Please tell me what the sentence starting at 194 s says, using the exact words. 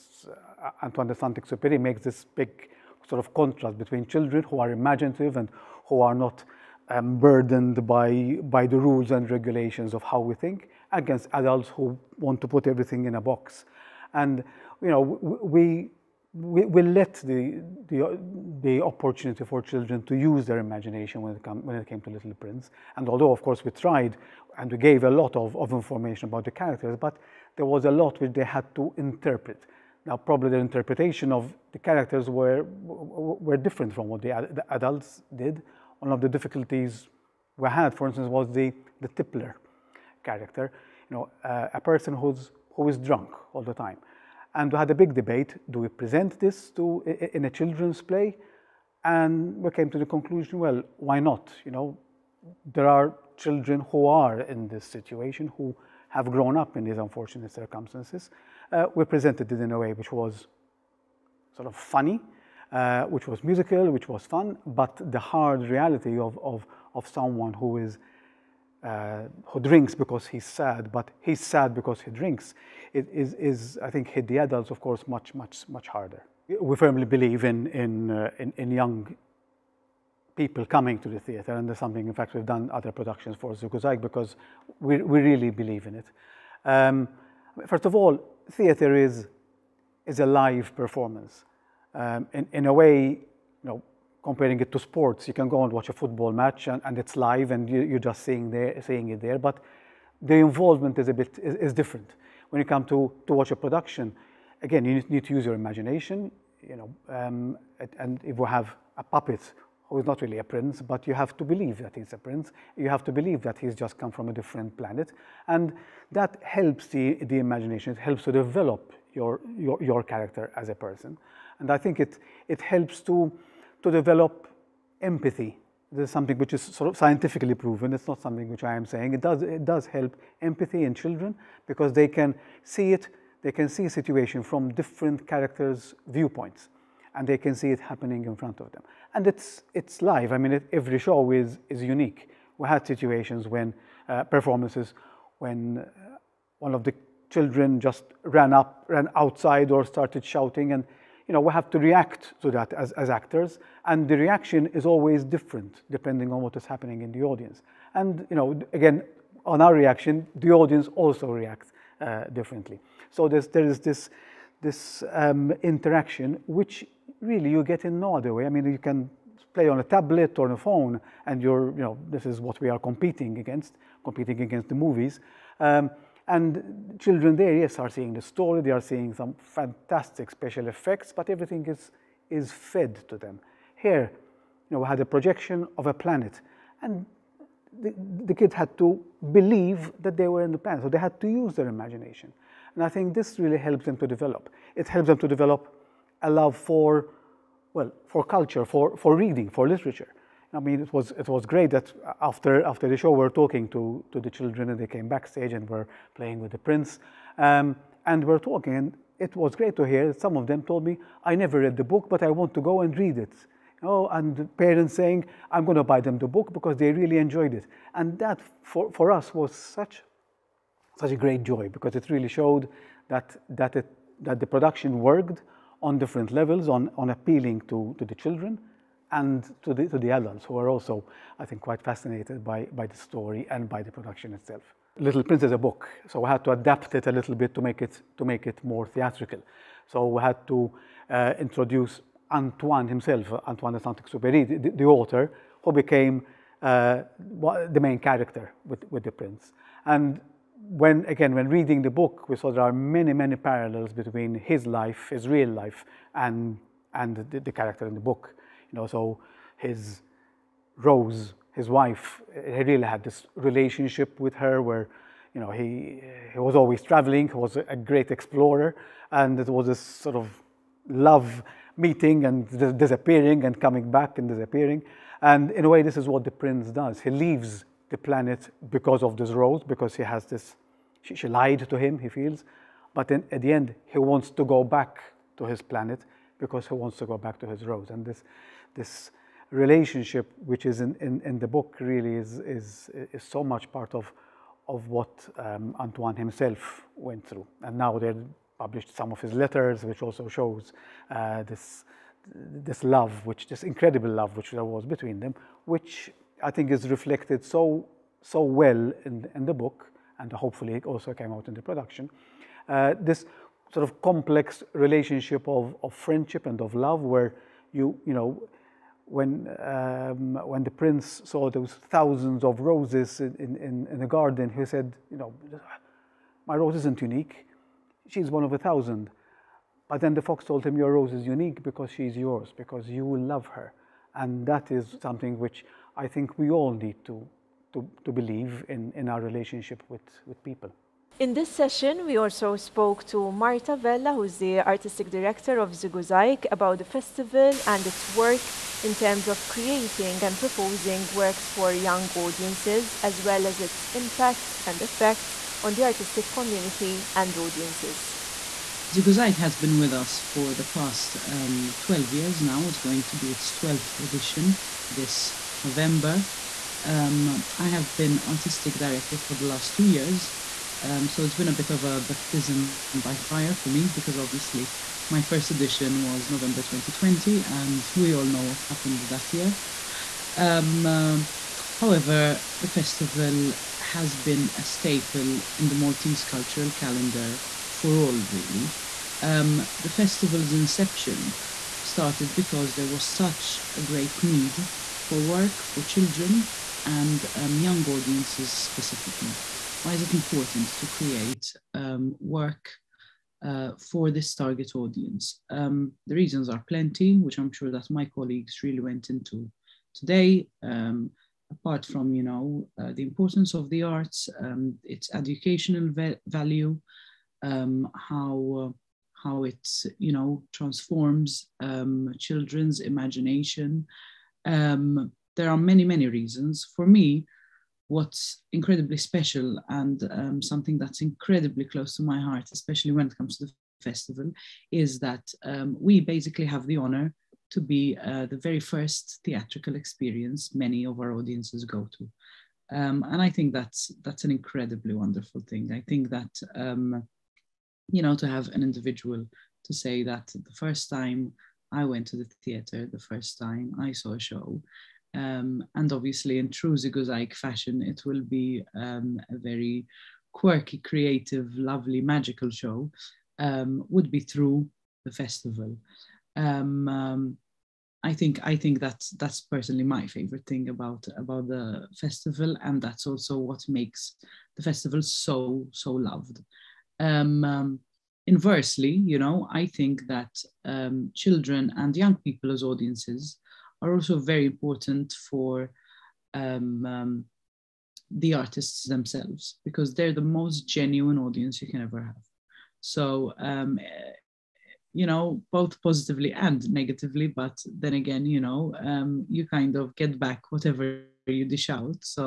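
It helps them to develop a love for well, for culture, for, for reading, for literature.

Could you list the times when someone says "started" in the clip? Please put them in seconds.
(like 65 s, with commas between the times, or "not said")
149 s, 391 s.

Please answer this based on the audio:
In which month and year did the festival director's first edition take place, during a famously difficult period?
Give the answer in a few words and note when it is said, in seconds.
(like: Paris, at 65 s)
November 2020, at 376 s.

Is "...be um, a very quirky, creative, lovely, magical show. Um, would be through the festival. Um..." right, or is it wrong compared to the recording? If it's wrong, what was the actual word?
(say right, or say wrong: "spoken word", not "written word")
right.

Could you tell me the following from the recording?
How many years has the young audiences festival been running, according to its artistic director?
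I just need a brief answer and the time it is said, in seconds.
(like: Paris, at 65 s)
12 years, at 361 s.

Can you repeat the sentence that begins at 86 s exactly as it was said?
Um, first of all, theater is, is a live performance.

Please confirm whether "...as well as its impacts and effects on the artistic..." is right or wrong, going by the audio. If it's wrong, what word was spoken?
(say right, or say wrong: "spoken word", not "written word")
right.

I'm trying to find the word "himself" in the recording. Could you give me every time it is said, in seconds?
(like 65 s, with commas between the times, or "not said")
242 s, 296 s.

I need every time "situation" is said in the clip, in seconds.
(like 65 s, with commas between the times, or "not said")
54 s, 133 s, 142 s.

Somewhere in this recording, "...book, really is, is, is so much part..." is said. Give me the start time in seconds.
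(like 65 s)
291 s.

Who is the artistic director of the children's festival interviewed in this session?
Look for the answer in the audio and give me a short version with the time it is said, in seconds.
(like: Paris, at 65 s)
Marta Vella, at 343 s.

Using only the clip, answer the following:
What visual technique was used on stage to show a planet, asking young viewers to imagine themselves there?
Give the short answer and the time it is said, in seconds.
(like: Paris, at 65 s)
A projection, at 185 s.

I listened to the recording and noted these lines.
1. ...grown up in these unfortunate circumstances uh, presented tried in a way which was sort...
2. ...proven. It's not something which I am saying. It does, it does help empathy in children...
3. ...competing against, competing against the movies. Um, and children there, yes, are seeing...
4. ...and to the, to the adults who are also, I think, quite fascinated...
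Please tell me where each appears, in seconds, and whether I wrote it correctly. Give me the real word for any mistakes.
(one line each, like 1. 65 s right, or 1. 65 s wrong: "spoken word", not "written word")
1. 56 s wrong: "presented", not "tried"
2. 127 s right
3. 172 s right
4. 229 s right.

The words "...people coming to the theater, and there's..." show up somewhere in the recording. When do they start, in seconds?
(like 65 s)
80 s.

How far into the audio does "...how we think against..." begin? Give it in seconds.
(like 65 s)
10 s.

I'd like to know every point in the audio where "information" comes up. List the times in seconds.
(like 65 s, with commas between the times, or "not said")
25 s.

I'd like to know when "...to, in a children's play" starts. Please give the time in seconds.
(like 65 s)
46 s.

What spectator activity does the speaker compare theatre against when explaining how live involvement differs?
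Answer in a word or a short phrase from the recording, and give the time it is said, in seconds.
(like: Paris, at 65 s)
A football match, at 95 s.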